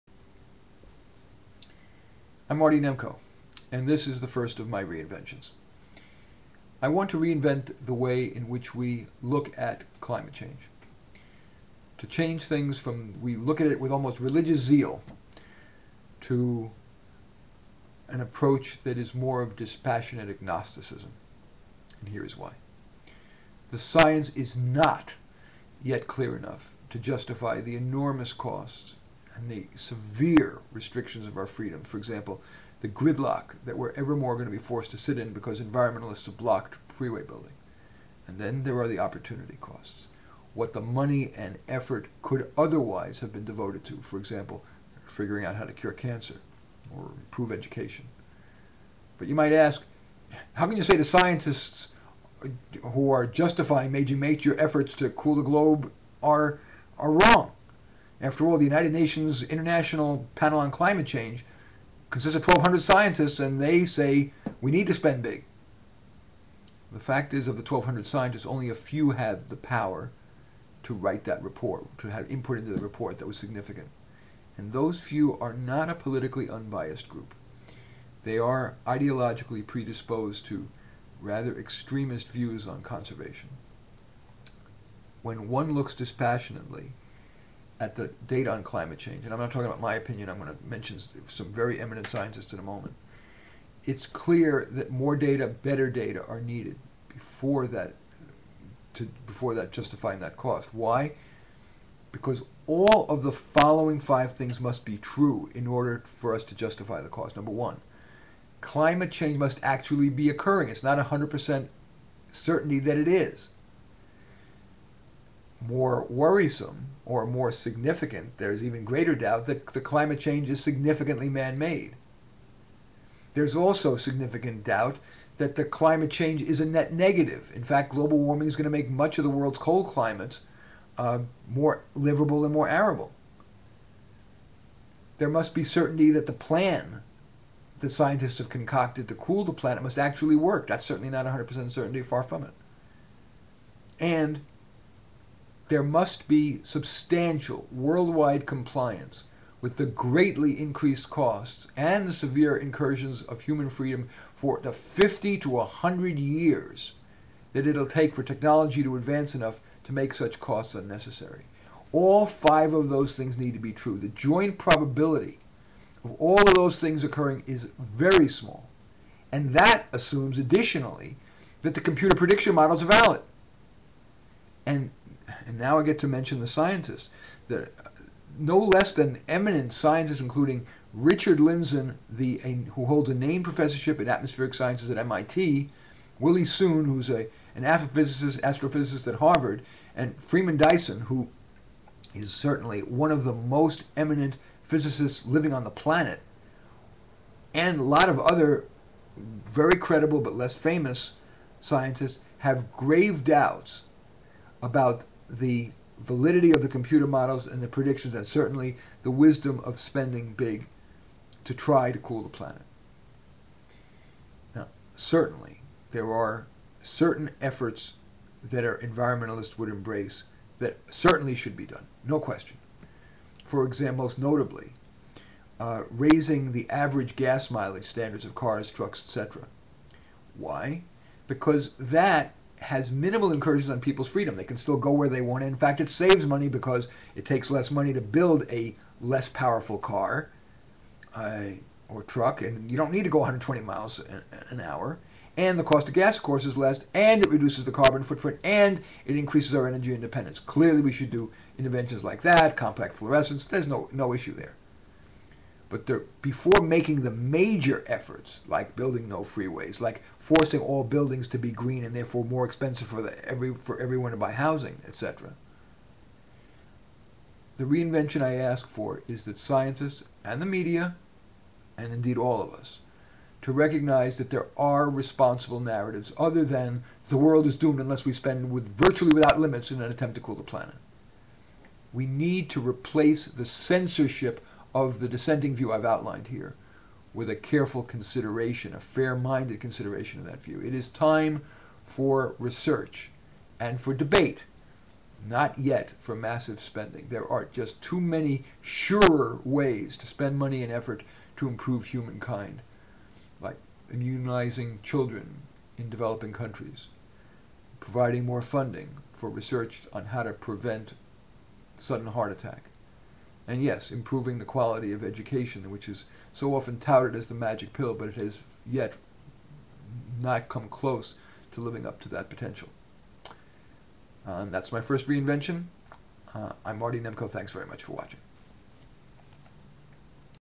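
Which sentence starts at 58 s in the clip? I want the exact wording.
After all, the United Nations International Panel on Climate Change consists of 1,200 scientists, and they say we need to spend big.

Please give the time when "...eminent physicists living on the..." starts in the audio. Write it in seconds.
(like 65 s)
193 s.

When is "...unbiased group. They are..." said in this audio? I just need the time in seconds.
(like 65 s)
76 s.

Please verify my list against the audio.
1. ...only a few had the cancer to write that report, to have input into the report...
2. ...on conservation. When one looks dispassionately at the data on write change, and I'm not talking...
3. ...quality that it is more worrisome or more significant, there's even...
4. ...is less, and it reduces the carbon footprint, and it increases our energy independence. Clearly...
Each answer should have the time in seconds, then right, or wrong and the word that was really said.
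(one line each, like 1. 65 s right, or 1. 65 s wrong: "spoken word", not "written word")
1. 68 s wrong: "power", not "cancer"
2. 82 s wrong: "climate", not "write"
3. 112 s wrong: "certainty", not "quality"
4. 246 s right.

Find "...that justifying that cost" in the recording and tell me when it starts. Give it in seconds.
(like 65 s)
99 s.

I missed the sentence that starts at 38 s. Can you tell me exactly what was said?
And then there are the opportunity costs.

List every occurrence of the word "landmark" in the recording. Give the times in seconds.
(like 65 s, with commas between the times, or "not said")
not said.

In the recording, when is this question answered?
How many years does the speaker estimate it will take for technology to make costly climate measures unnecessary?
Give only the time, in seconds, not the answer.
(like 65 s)
154 s.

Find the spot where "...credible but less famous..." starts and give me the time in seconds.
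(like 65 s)
199 s.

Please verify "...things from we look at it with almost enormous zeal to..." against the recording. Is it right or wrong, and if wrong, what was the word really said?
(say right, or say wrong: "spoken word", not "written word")
wrong: "religious", not "enormous".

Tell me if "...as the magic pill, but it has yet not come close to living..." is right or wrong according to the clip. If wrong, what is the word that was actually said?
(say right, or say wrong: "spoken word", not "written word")
right.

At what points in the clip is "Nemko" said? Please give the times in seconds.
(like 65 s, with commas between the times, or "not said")
2 s, 326 s.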